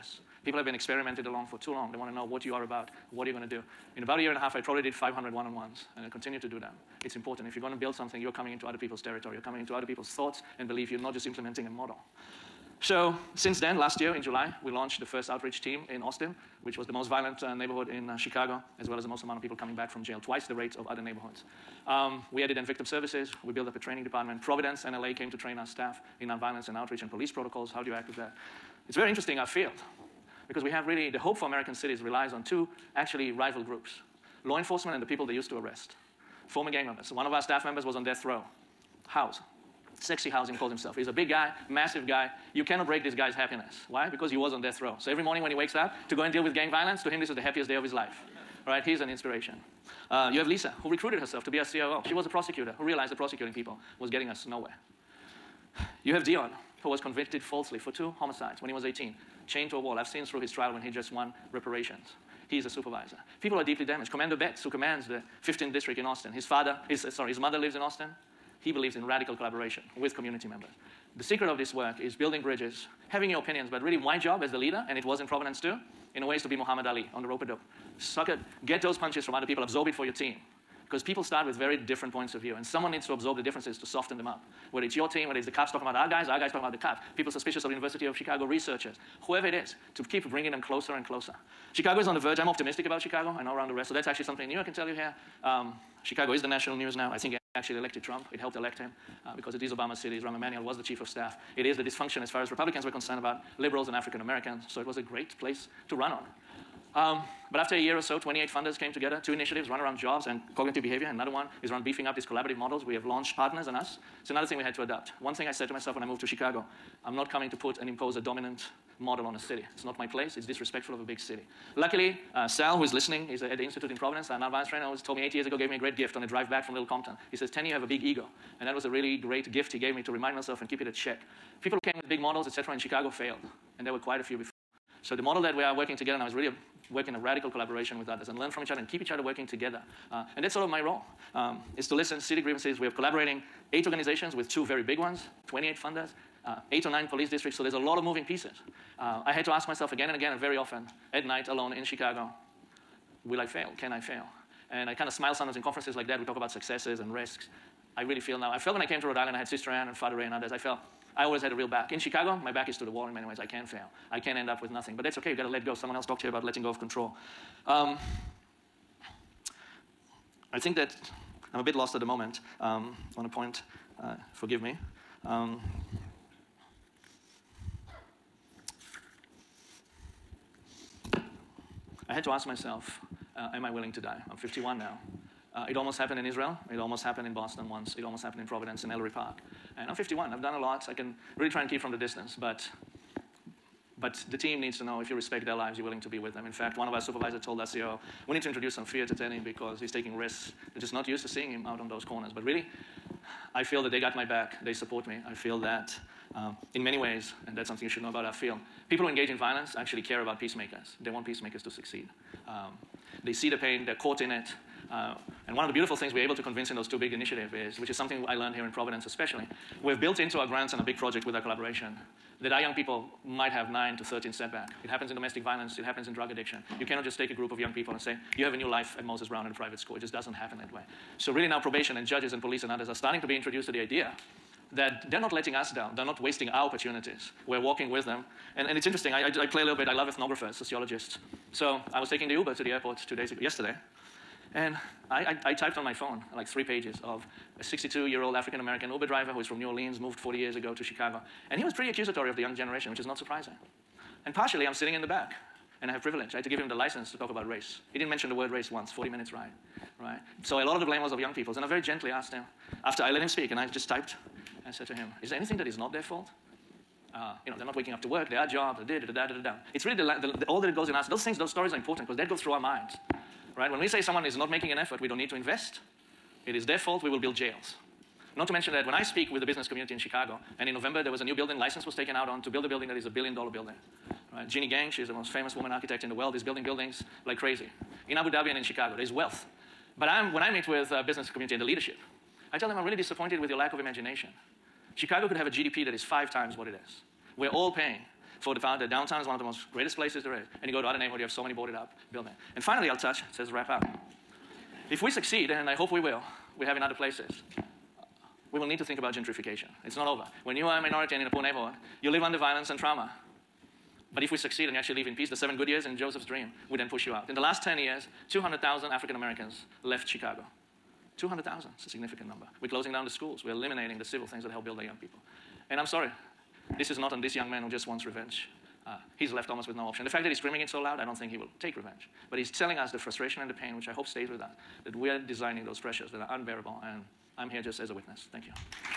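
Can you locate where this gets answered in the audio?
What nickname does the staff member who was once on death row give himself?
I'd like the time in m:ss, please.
0:39.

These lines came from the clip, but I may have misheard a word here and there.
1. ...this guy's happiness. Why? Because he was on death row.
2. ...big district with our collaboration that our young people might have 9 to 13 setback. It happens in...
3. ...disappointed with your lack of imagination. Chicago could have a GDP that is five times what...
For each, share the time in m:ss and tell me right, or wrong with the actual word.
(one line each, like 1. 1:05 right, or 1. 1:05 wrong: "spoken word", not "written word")
1. 0:43 right
2. 3:40 wrong: "project", not "district"
3. 4:52 right.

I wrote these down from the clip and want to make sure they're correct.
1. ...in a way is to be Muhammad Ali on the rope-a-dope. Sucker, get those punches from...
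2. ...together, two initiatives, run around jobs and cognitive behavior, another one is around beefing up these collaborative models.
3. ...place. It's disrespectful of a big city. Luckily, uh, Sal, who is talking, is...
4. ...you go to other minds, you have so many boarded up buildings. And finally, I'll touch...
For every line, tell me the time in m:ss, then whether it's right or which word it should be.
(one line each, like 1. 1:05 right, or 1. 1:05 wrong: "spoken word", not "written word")
1. 1:16 right
2. 1:48 right
3. 2:00 wrong: "listening", not "talking"
4. 5:00 wrong: "neighborhoods", not "minds".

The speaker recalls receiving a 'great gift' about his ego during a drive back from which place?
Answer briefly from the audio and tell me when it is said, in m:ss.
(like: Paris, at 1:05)
Little Compton, at 2:06.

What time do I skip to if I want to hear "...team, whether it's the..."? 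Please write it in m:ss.
1:25.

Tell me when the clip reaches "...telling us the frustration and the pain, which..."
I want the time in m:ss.
5:32.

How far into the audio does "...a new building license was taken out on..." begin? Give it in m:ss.
4:41.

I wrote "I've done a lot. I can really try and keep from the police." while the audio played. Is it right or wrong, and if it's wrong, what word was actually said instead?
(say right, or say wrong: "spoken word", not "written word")
wrong: "distance", not "police".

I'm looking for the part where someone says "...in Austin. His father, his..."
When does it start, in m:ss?
1:05.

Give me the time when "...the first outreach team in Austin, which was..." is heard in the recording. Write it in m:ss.
0:15.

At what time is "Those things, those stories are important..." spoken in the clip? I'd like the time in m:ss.
4:31.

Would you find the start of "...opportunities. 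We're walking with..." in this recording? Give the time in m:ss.
3:56.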